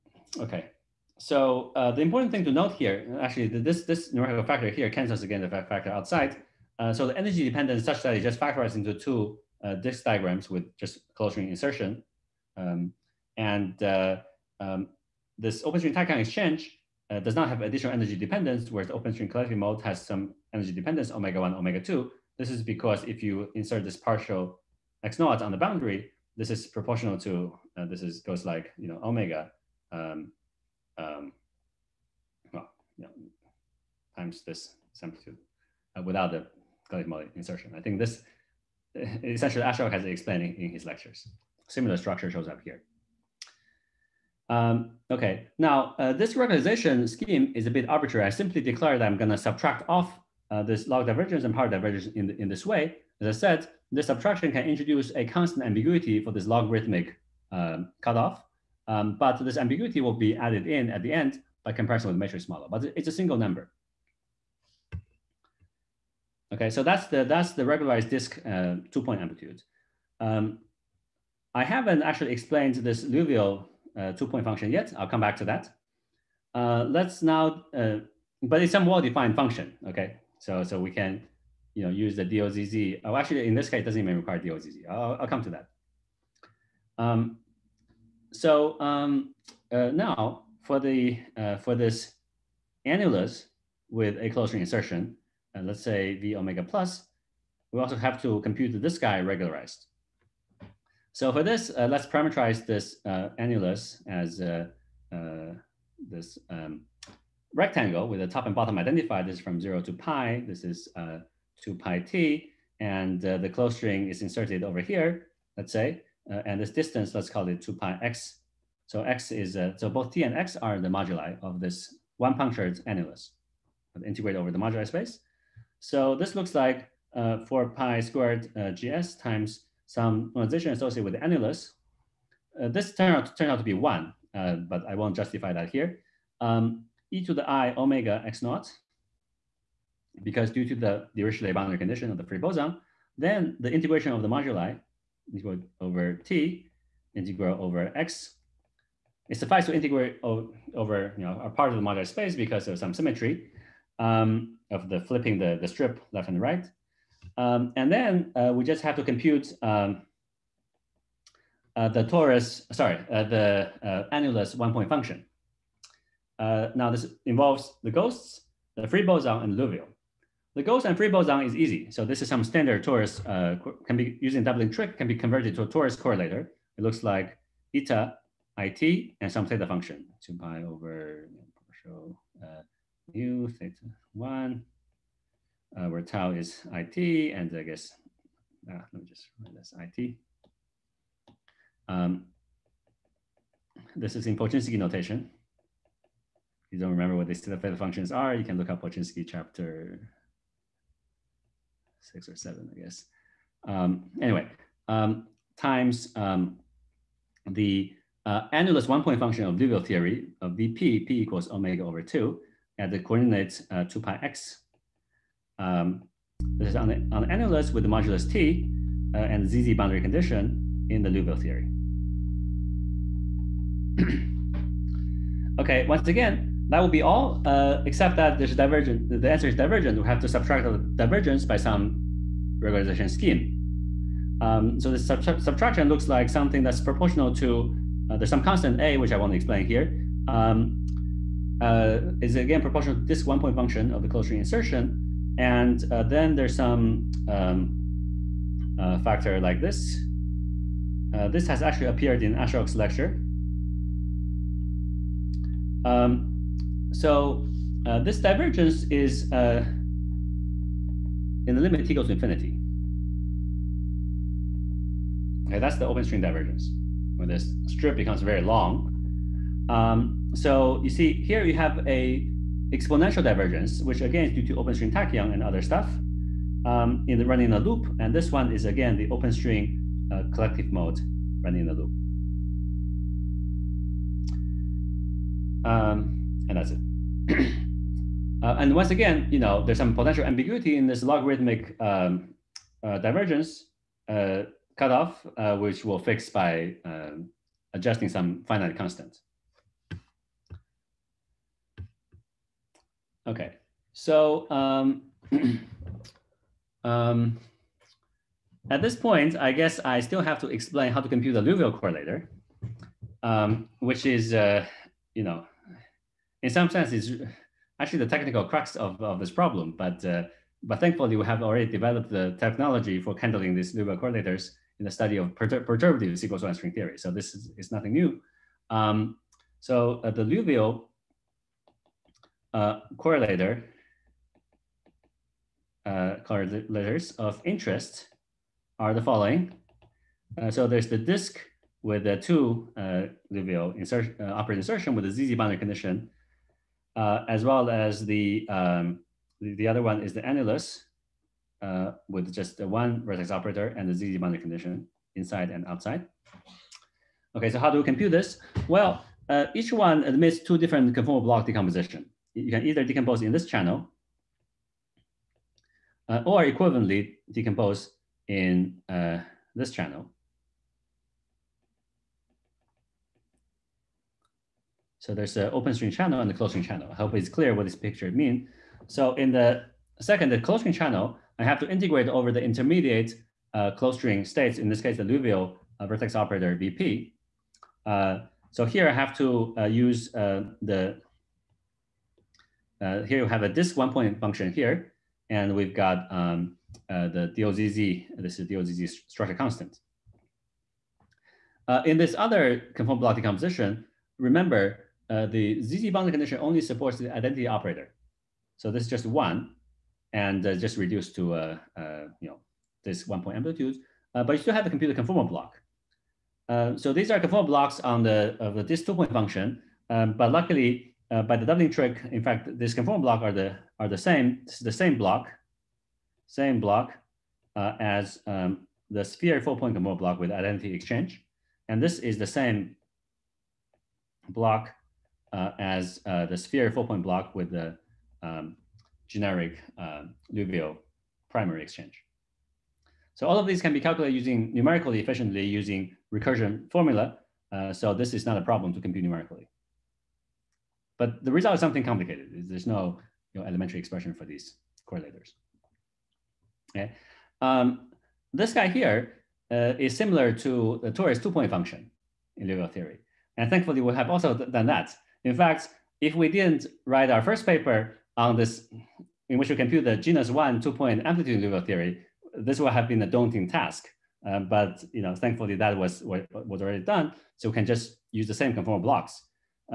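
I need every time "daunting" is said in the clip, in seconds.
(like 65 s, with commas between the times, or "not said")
473 s.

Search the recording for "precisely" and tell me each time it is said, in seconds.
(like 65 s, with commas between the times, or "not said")
not said.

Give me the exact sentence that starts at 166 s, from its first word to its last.
Uh, now this involves the ghosts, the free boson and Liouville.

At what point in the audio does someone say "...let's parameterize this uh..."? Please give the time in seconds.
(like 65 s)
101 s.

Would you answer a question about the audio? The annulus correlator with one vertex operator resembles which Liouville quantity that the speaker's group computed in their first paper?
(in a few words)
torus two-point function.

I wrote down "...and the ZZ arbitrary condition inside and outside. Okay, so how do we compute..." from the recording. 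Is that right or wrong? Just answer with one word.
wrong.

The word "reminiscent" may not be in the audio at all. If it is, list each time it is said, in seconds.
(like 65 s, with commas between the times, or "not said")
not said.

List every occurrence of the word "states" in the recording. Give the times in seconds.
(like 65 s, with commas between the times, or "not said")
384 s.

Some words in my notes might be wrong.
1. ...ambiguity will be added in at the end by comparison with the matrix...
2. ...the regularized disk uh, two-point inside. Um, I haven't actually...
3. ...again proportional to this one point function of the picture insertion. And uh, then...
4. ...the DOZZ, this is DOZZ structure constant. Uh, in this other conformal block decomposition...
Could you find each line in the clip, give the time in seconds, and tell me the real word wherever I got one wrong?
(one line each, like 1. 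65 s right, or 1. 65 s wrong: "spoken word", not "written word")
1. 59 s right
2. 67 s wrong: "amplitude", not "inside"
3. 242 s wrong: "closure", not "picture"
4. 397 s right.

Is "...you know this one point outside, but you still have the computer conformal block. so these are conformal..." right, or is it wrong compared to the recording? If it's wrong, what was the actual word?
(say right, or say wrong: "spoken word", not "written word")
wrong: "amplitude", not "outside".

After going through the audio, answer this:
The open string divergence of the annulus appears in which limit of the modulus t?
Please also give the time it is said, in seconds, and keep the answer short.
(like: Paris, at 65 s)
t goes to infinity, at 261 s.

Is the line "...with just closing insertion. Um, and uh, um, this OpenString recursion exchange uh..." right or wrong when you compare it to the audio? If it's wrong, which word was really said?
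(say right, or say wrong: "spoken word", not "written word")
wrong: "tachyon", not "recursion".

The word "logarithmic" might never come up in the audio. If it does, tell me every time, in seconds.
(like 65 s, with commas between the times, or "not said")
56 s, 291 s.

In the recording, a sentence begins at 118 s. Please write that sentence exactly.
So x is, so both t and x are the moduli of this one punctured annulus integrate over the moduli space.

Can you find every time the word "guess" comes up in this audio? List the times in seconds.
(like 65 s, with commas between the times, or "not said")
187 s, 202 s, 309 s.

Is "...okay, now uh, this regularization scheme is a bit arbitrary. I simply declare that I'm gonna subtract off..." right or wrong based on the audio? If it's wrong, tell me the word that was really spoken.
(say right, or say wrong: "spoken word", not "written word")
right.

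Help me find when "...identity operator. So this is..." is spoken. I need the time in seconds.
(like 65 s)
407 s.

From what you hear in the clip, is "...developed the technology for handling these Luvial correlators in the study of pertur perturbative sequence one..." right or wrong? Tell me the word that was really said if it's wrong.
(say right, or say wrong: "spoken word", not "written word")
right.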